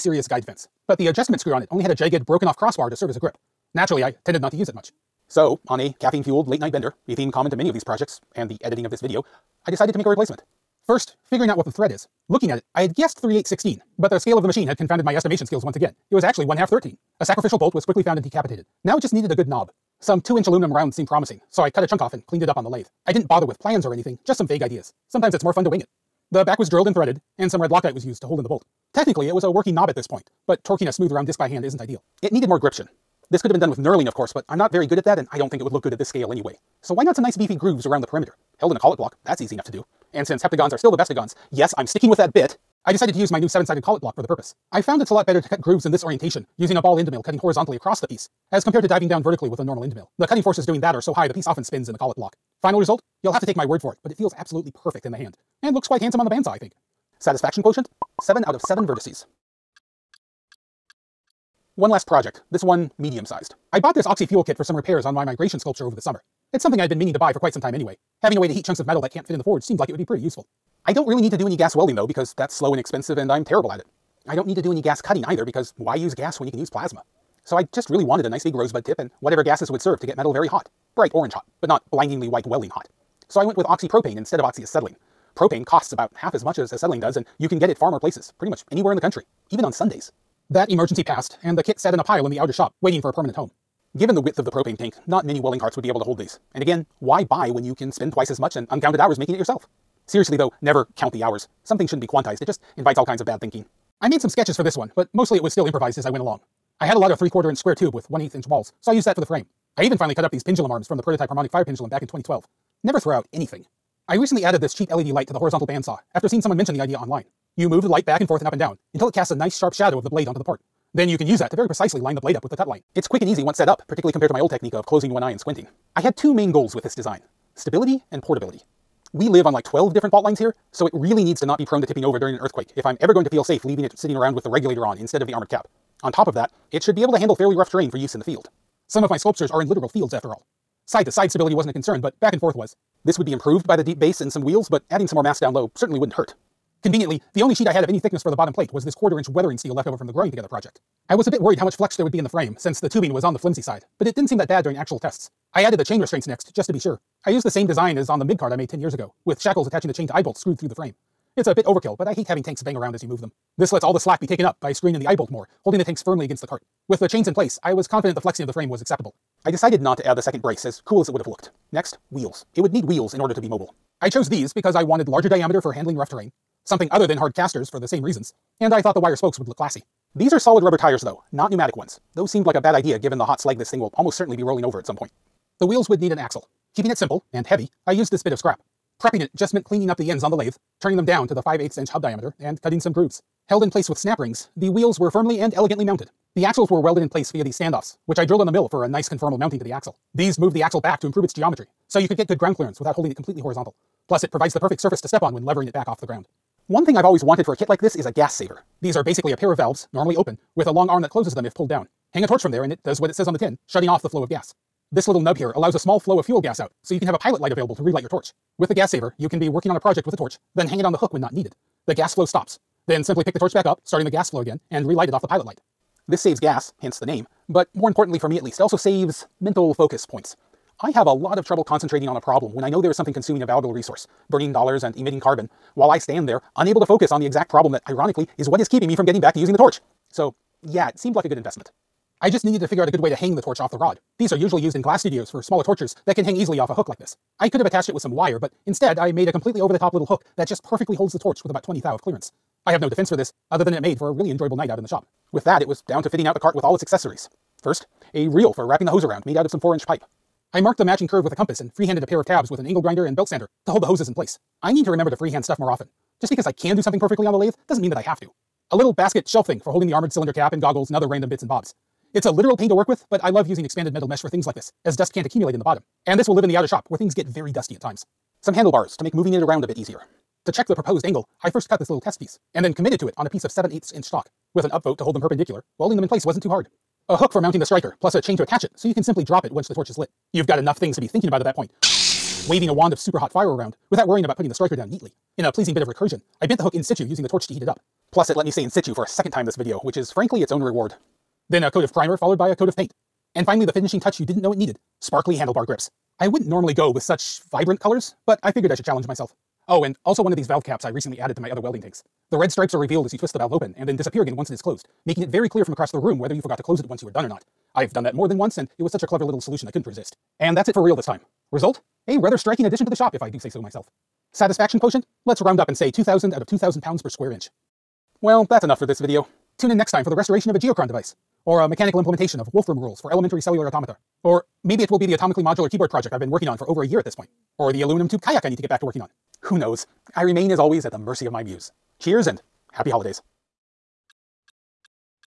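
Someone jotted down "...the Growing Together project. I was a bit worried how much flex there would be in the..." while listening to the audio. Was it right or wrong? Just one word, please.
right.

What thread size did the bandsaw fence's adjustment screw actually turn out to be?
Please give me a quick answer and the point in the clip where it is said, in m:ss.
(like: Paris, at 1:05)
1/2-13, at 0:16.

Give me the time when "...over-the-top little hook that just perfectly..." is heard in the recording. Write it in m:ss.
4:09.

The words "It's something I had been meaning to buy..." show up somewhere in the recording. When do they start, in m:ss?
1:06.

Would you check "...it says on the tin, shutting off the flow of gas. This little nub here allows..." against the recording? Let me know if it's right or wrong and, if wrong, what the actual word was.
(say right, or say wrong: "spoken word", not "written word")
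right.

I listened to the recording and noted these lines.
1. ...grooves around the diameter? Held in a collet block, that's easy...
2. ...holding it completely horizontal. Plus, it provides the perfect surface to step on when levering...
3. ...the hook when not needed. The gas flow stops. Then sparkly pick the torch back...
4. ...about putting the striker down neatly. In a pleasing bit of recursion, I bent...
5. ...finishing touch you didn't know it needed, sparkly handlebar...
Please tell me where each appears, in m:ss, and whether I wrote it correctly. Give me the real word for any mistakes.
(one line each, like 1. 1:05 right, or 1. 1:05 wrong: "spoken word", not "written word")
1. 0:37 wrong: "perimeter", not "diameter"
2. 3:22 right
3. 3:40 wrong: "simply", not "sparkly"
4. 4:54 right
5. 5:03 right.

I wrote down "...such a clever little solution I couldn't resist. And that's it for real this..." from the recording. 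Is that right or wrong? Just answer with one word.
right.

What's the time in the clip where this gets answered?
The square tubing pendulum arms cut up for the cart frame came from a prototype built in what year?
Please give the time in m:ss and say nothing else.
1:52.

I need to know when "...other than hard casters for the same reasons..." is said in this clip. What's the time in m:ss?
2:56.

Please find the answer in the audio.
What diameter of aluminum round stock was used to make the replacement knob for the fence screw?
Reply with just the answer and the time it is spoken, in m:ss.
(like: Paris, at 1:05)
2-inch, at 0:20.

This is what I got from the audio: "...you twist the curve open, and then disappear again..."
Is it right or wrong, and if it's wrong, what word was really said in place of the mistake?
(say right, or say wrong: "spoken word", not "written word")
wrong: "valve", not "curve".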